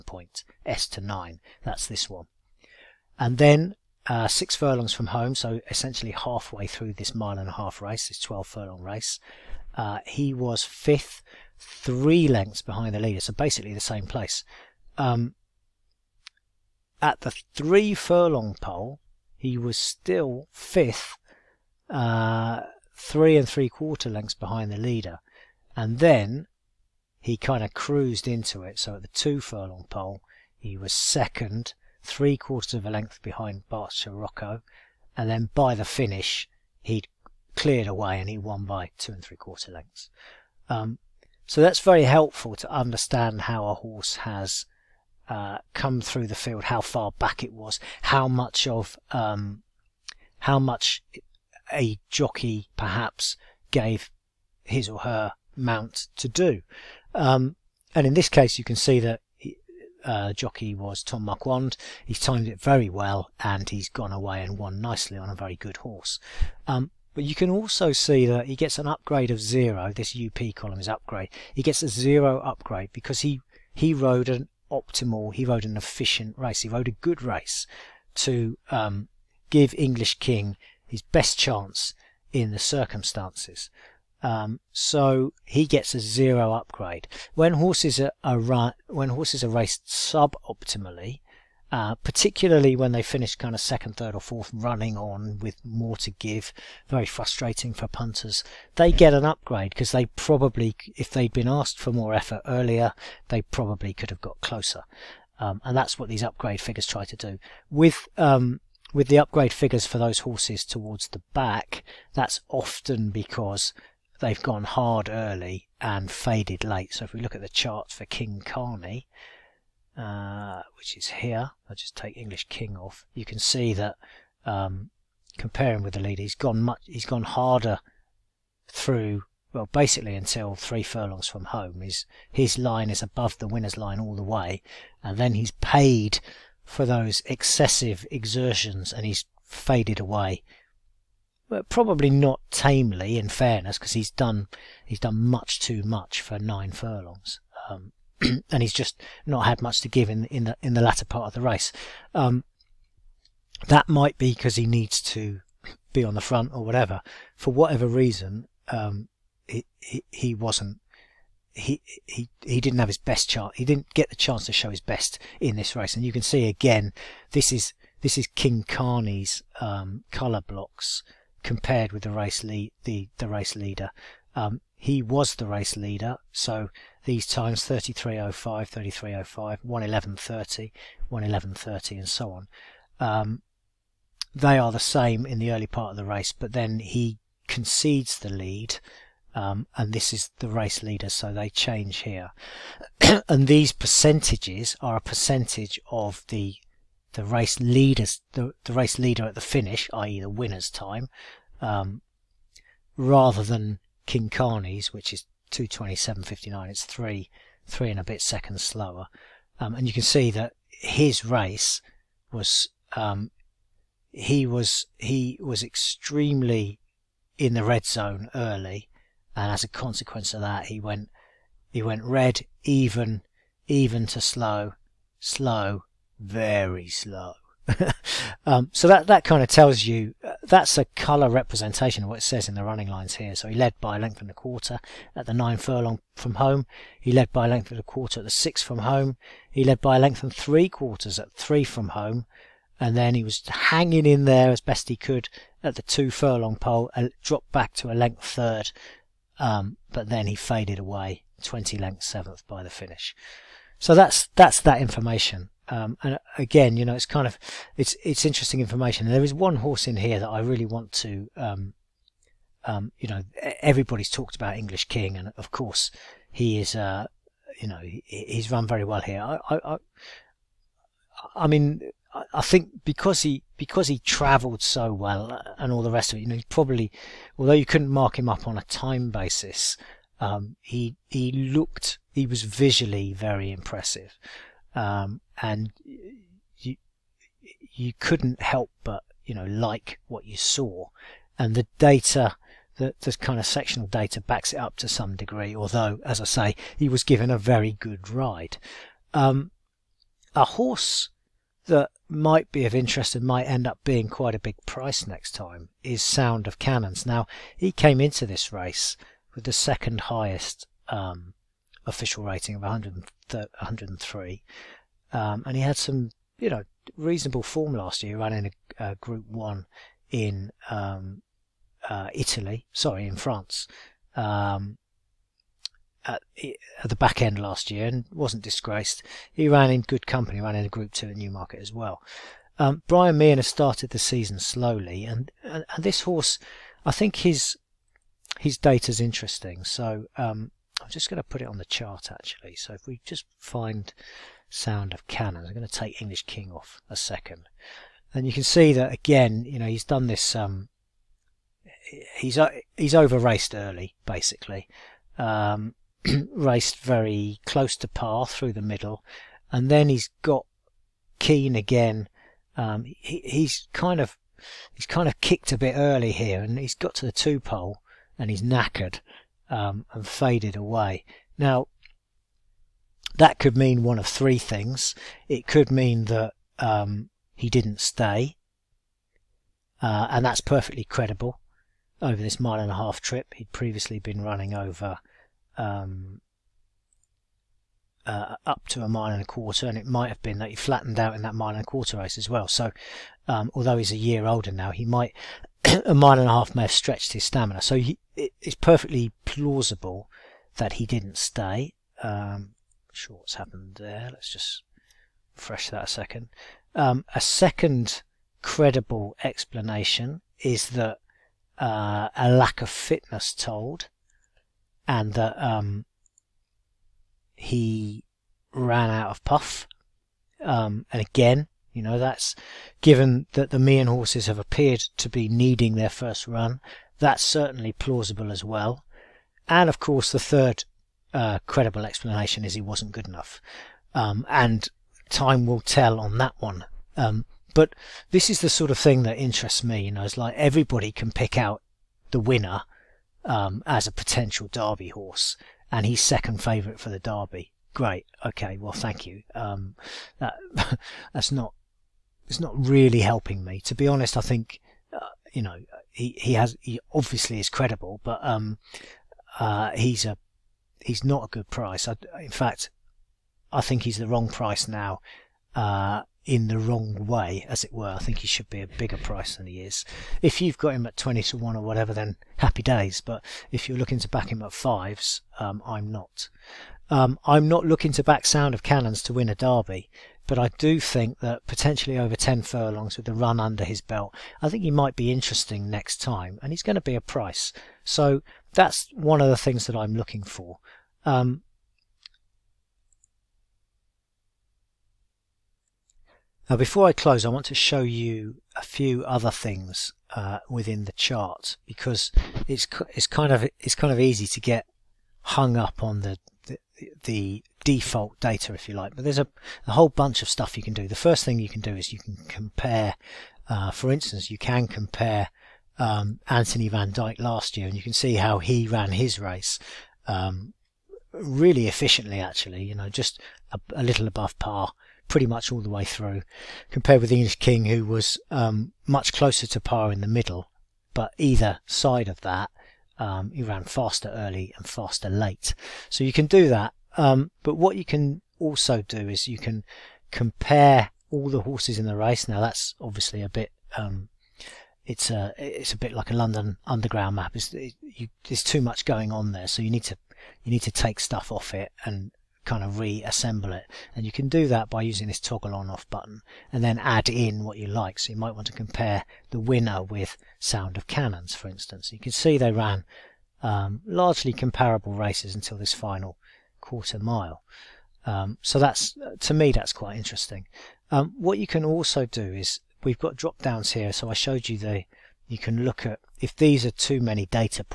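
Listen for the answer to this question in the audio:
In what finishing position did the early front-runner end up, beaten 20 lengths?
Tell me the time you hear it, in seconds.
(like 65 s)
252 s.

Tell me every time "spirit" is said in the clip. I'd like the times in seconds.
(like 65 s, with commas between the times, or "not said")
not said.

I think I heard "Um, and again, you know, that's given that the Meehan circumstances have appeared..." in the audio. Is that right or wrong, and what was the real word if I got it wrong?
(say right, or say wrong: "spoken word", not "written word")
wrong: "horses", not "circumstances".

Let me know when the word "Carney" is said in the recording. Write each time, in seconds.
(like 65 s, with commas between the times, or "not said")
118 s, 168 s, 204 s.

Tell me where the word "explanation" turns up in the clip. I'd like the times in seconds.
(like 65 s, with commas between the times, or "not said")
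409 s, 431 s.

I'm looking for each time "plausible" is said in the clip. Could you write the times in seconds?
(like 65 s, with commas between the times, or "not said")
399 s, 427 s.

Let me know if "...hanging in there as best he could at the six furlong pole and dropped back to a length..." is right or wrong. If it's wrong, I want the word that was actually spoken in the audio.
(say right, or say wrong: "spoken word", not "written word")
wrong: "two", not "six".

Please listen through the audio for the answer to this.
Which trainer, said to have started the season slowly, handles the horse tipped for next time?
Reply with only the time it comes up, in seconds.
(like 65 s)
332 s.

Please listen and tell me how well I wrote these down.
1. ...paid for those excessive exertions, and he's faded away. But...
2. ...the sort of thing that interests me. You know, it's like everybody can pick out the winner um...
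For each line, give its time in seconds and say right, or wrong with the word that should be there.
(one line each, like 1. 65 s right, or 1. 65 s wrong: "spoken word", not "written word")
1. 135 s right
2. 438 s right.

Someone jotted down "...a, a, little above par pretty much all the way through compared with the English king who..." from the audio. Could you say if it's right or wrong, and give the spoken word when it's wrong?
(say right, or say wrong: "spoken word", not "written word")
right.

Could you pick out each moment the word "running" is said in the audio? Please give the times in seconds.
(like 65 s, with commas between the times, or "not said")
94 s, 232 s, 318 s, 384 s.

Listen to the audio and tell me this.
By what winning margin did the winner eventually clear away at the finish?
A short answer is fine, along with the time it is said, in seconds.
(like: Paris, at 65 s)
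2 and 3/4 lengths, at 38 s.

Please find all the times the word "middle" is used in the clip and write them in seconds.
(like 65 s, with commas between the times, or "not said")
358 s, 530 s.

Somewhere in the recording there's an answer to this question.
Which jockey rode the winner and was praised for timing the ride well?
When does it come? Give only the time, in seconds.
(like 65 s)
61 s.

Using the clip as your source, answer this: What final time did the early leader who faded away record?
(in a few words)
227.59.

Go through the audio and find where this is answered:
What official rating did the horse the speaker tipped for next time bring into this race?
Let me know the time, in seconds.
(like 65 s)
312 s.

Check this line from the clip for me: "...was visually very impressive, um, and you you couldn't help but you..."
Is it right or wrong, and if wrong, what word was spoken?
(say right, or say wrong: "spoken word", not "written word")
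right.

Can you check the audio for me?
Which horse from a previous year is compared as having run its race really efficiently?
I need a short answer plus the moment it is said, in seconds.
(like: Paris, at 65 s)
Anthony Van Dyck, at 516 s.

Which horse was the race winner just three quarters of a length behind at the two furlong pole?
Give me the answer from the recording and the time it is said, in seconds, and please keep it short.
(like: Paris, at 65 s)
Bart Sirocco, at 33 s.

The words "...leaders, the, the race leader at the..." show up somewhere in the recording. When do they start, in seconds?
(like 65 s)
197 s.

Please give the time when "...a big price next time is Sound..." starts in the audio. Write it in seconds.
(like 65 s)
304 s.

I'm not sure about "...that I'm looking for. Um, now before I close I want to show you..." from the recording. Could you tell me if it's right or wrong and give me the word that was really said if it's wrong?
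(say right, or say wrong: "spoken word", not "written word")
right.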